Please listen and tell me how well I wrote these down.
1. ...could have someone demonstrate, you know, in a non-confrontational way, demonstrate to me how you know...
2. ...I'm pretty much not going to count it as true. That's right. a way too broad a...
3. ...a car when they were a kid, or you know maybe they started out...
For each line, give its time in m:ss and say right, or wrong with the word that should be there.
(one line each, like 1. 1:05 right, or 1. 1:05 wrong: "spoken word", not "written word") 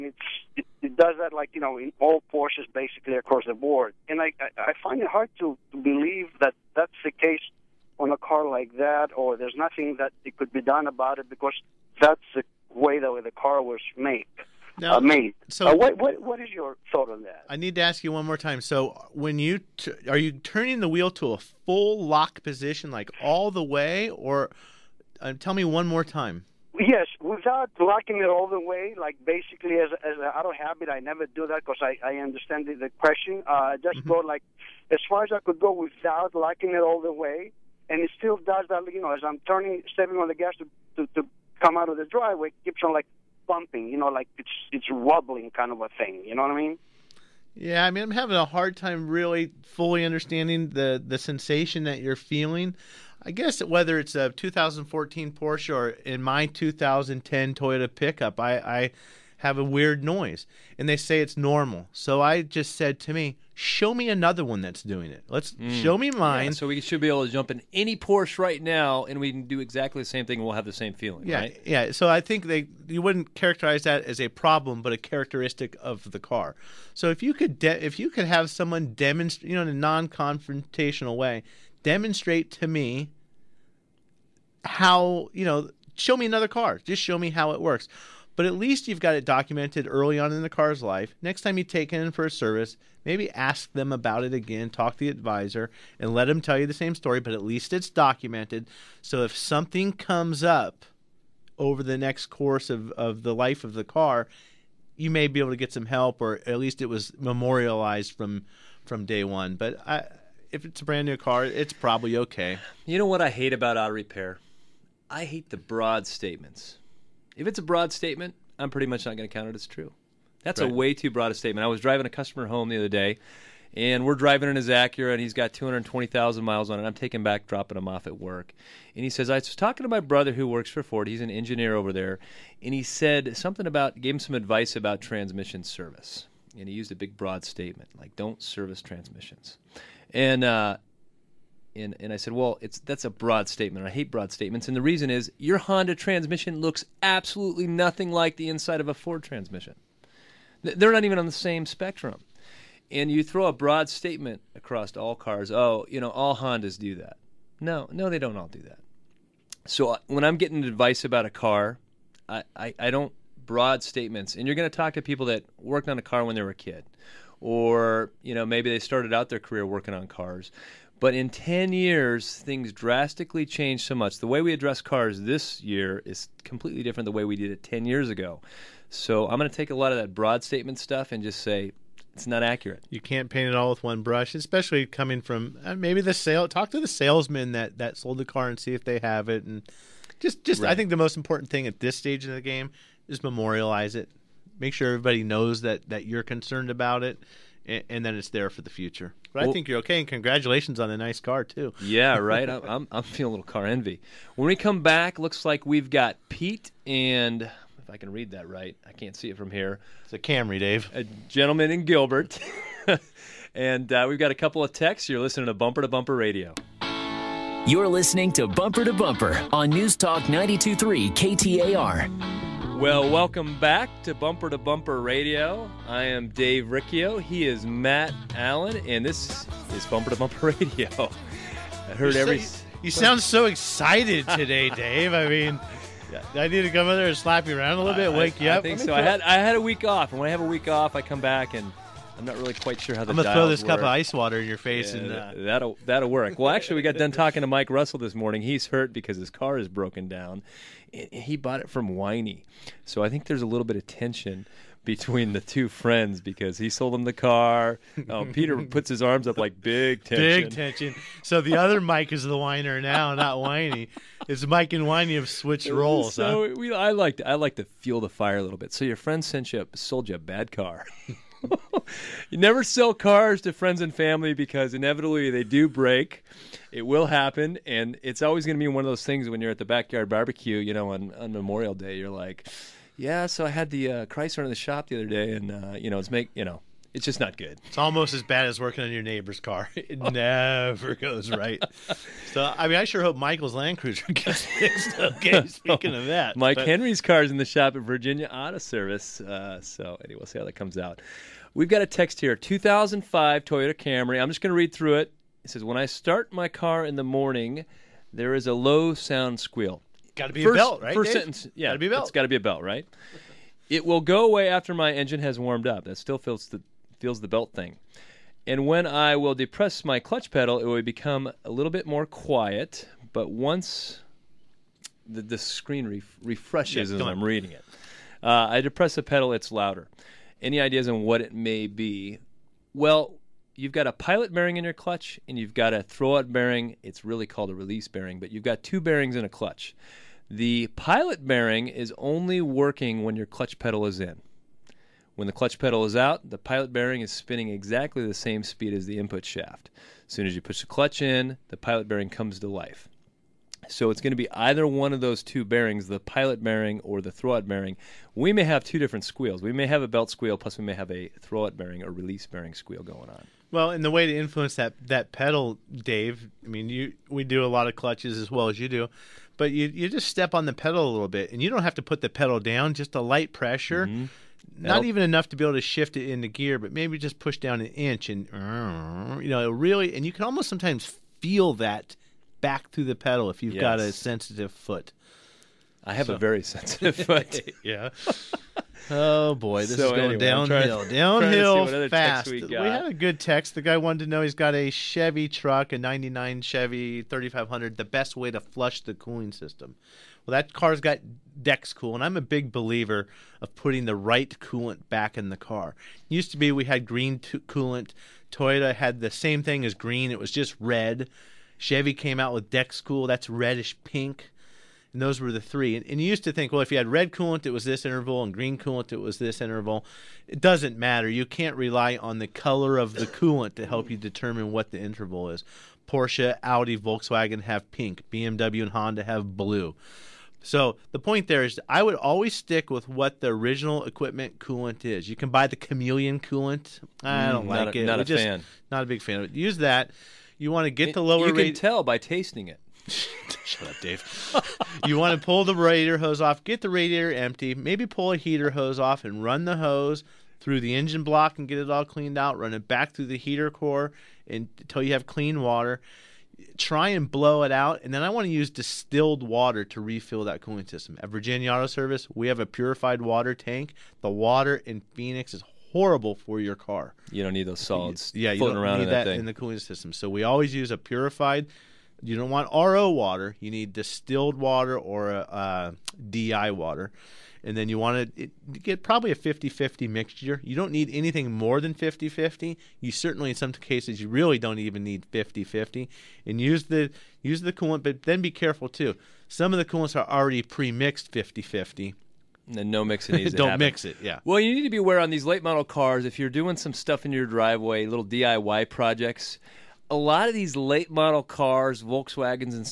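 1. 1:18 right
2. 1:58 right
3. 2:45 right.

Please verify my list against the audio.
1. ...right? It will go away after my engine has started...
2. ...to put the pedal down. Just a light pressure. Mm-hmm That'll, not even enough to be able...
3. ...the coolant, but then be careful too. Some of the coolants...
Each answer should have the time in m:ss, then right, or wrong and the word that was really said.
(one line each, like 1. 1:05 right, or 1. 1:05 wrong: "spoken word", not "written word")
1. 5:12 wrong: "warmed", not "started"
2. 6:11 right
3. 8:07 right.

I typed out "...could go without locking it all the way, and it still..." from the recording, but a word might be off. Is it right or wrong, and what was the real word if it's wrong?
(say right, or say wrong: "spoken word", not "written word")
right.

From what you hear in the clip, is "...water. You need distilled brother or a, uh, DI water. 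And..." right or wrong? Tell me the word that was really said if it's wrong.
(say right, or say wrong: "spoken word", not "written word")
wrong: "water", not "brother".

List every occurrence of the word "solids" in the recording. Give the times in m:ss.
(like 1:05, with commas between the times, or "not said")
7:47.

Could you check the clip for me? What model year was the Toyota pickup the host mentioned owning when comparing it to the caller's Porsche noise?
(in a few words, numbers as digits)
2010.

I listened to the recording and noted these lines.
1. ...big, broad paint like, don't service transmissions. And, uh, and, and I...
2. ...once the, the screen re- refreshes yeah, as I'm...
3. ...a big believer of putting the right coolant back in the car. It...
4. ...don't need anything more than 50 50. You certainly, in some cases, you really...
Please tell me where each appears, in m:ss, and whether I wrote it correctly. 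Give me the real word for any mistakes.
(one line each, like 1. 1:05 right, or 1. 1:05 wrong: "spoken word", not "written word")
1. 2:16 wrong: "statement", not "paint"
2. 5:23 right
3. 6:42 right
4. 8:00 right.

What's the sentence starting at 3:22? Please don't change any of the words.
I'm I'm feeling a little car envy.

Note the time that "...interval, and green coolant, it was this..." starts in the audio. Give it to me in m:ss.
6:57.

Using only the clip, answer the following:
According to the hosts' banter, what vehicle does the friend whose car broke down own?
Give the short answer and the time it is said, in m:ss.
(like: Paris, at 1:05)
Land Cruiser, at 4:53.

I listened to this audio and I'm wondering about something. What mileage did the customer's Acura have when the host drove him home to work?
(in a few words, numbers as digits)
220,000.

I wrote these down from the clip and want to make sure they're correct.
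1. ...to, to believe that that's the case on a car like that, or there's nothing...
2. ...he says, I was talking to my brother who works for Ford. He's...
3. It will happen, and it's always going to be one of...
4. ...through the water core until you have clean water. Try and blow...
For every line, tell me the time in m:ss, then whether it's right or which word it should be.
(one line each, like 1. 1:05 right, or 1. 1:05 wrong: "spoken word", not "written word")
1. 0:05 right
2. 2:09 right
3. 4:36 right
4. 7:32 wrong: "heater", not "water".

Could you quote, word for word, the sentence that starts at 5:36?
It's really called a release bearing, but you've got two bearings in a clutch.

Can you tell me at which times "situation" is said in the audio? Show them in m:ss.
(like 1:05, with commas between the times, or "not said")
not said.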